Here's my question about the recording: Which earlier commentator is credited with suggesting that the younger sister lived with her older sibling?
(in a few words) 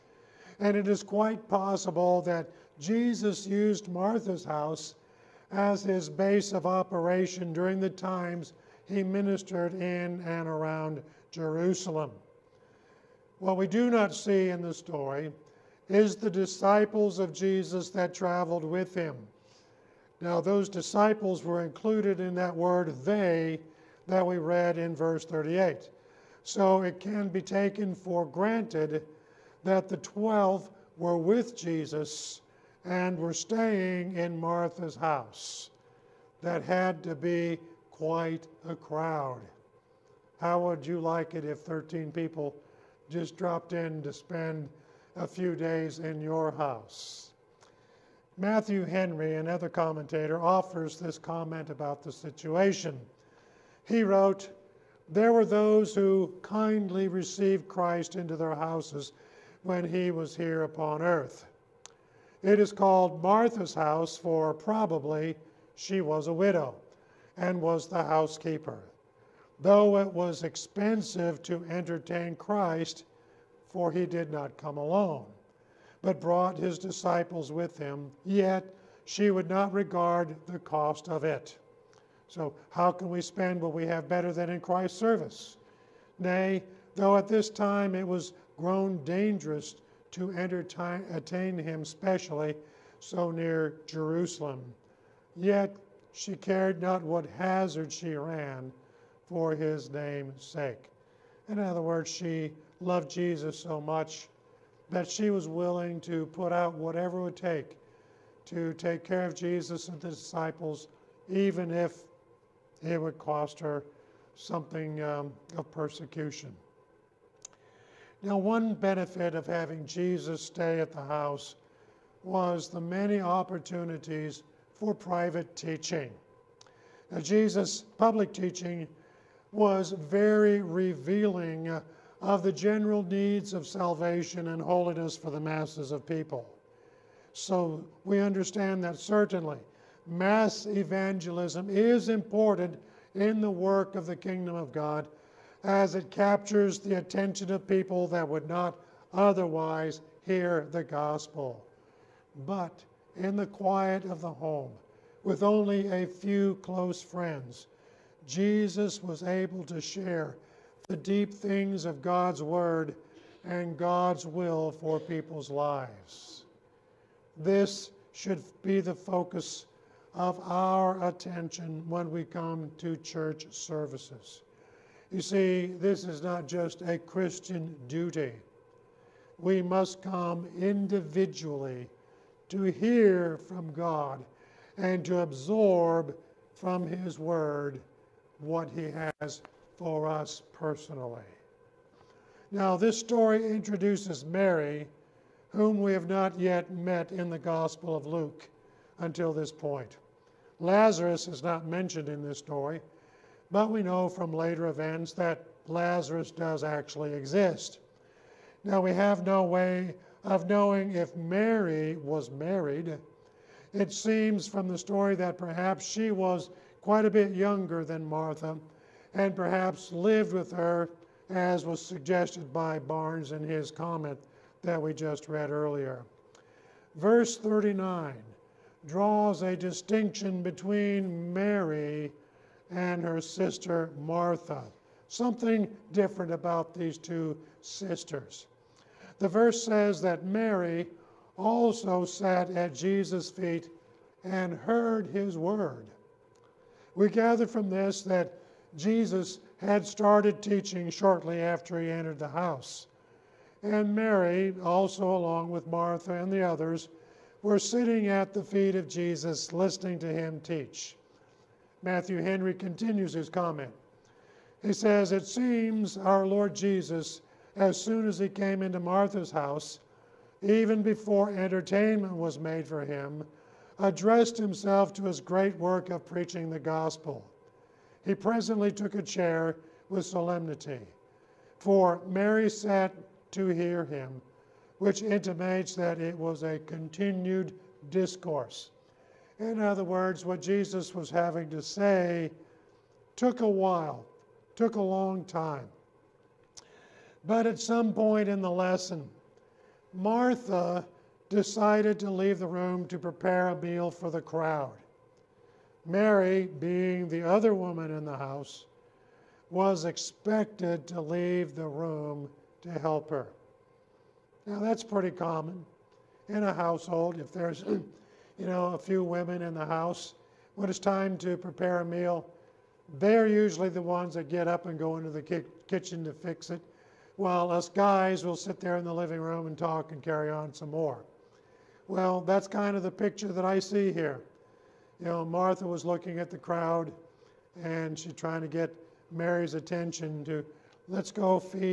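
Barnes.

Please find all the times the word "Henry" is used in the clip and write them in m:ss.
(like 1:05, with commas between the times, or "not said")
0:48, 4:22.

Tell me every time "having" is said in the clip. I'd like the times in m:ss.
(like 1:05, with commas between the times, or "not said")
1:59, 4:51.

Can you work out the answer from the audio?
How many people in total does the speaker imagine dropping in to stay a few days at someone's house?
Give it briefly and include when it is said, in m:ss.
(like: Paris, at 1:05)
13, at 0:41.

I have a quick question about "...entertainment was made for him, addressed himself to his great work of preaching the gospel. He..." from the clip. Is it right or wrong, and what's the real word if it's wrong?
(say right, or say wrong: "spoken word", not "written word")
right.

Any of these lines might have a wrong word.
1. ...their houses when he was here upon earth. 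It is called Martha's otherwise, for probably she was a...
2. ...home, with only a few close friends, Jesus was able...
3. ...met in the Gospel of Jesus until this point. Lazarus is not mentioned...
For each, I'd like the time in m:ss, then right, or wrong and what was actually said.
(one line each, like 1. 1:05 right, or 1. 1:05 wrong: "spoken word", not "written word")
1. 0:58 wrong: "house", not "otherwise"
2. 2:34 right
3. 3:16 wrong: "Luke", not "Jesus".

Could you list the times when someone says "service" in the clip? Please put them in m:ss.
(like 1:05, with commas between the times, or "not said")
1:24, 2:53.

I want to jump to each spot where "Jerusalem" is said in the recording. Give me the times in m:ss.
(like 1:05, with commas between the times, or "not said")
0:11, 1:33.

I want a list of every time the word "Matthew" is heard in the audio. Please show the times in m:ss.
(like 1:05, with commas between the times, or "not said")
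0:48, 4:21.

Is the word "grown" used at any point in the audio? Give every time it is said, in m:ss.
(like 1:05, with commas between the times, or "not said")
1:28.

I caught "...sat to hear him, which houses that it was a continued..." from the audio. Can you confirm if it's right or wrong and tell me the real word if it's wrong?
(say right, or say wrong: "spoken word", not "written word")
wrong: "intimates", not "houses".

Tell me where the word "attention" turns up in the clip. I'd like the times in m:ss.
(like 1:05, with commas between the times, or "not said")
2:26, 2:51, 5:39.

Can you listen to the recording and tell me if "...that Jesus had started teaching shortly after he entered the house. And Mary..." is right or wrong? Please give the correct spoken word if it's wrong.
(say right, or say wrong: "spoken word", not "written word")
right.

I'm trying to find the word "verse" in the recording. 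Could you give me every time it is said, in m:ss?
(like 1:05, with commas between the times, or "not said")
0:24, 3:46, 3:59.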